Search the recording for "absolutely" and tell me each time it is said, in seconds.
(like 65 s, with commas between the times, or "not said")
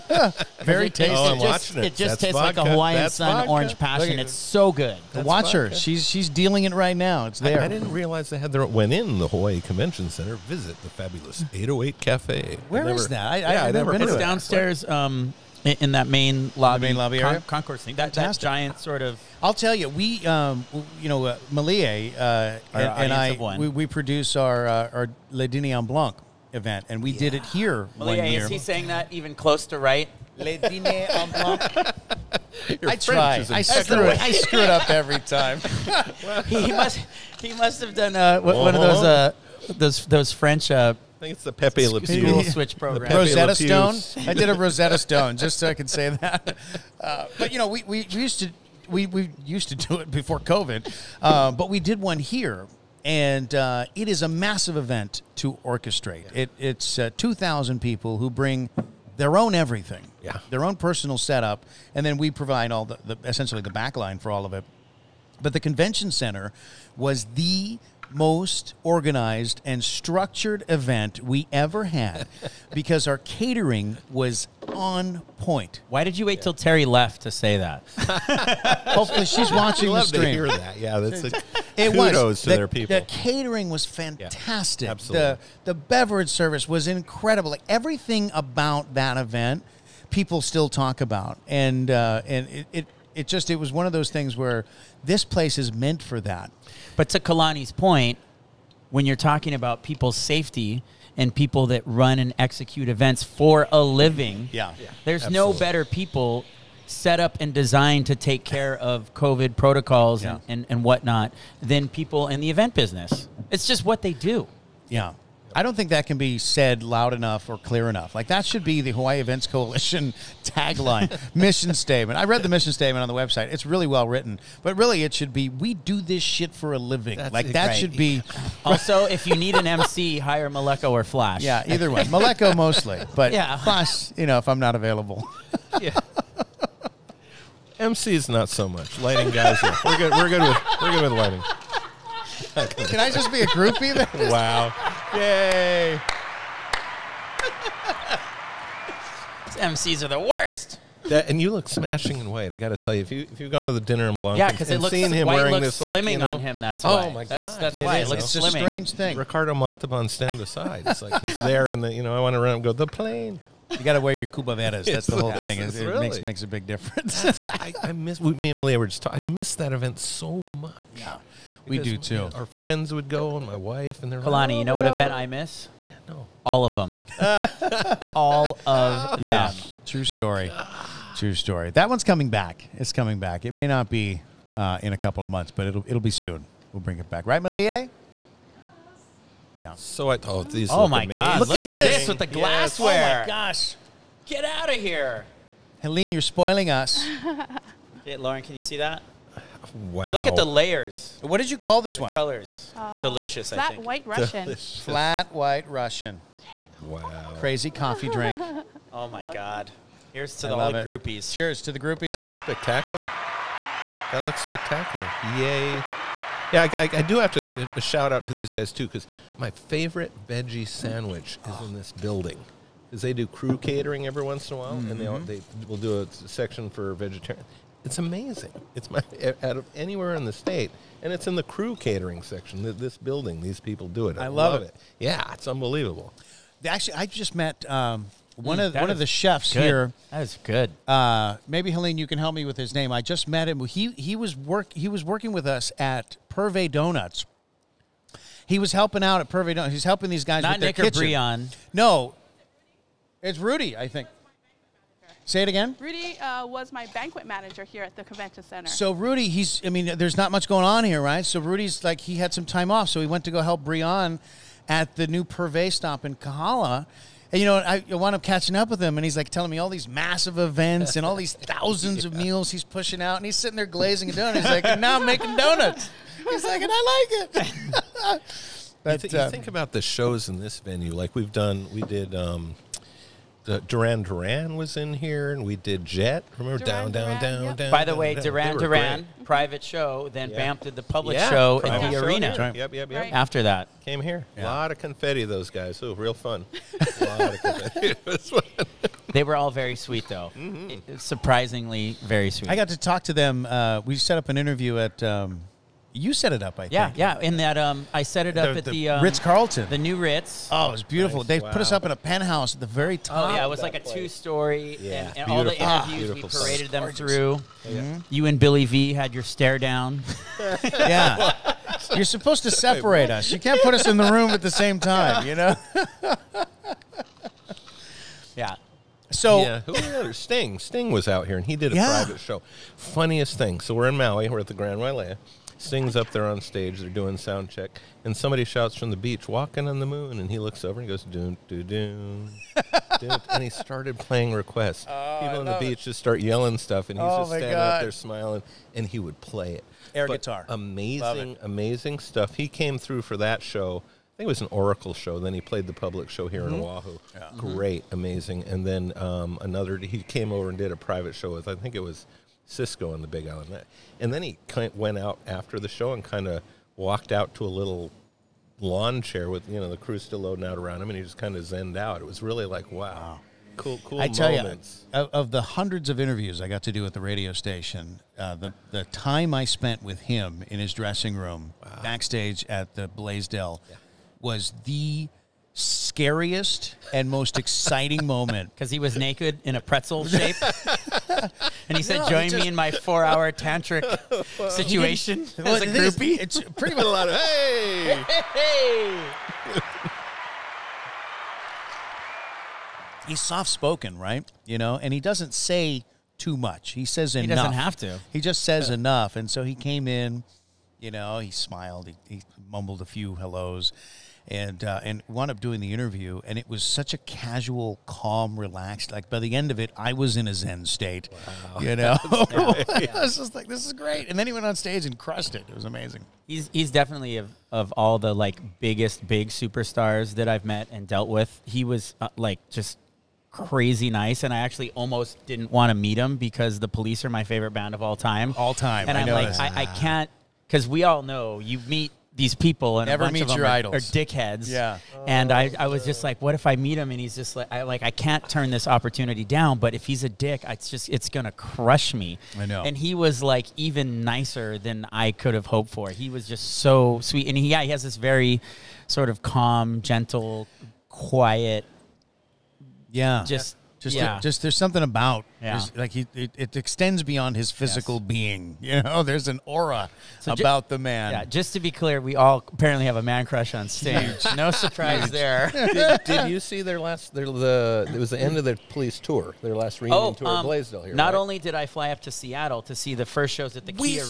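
84 s, 105 s.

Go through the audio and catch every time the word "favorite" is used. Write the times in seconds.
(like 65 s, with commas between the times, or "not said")
219 s, 437 s.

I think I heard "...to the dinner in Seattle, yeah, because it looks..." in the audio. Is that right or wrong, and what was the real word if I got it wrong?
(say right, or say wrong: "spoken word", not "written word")
wrong: "Blanc", not "Seattle".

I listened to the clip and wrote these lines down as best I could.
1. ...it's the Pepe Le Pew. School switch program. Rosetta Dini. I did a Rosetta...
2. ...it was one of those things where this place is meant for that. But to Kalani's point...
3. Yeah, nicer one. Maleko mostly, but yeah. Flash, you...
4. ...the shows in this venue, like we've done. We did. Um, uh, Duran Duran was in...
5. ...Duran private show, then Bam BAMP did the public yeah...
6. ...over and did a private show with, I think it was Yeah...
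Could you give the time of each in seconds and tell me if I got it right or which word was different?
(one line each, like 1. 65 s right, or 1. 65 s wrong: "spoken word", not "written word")
1. 41 s wrong: "Stone", not "Dini"
2. 93 s right
3. 131 s wrong: "either", not "nicer"
4. 279 s right
5. 288 s right
6. 360 s wrong: "Cisco", not "Yeah".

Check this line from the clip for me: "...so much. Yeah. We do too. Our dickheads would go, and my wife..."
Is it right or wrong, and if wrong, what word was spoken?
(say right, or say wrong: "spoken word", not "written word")
wrong: "friends", not "dickheads".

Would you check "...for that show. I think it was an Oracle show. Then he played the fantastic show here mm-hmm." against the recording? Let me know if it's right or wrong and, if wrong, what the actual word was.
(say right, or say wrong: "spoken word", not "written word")
wrong: "public", not "fantastic".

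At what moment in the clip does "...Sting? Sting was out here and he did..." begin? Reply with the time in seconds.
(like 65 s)
330 s.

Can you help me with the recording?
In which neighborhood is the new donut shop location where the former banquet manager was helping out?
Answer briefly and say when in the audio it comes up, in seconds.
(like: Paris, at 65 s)
Kahala, at 266 s.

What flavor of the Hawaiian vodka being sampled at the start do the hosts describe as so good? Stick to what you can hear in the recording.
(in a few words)
Orange passion.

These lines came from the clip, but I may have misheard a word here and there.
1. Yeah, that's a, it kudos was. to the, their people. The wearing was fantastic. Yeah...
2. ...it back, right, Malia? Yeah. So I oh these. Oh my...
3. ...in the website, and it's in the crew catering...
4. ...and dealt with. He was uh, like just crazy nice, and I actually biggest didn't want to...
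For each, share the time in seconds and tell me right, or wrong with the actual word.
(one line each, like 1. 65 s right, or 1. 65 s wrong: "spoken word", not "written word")
1. 80 s wrong: "catering", not "wearing"
2. 186 s right
3. 230 s wrong: "state", not "website"
4. 430 s wrong: "almost", not "biggest".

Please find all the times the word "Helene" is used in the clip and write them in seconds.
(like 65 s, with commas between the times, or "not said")
195 s, 241 s.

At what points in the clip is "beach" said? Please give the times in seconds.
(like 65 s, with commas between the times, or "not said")
338 s, 345 s.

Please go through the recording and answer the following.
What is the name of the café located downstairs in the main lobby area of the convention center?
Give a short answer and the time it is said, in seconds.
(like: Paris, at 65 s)
808 Cafe, at 11 s.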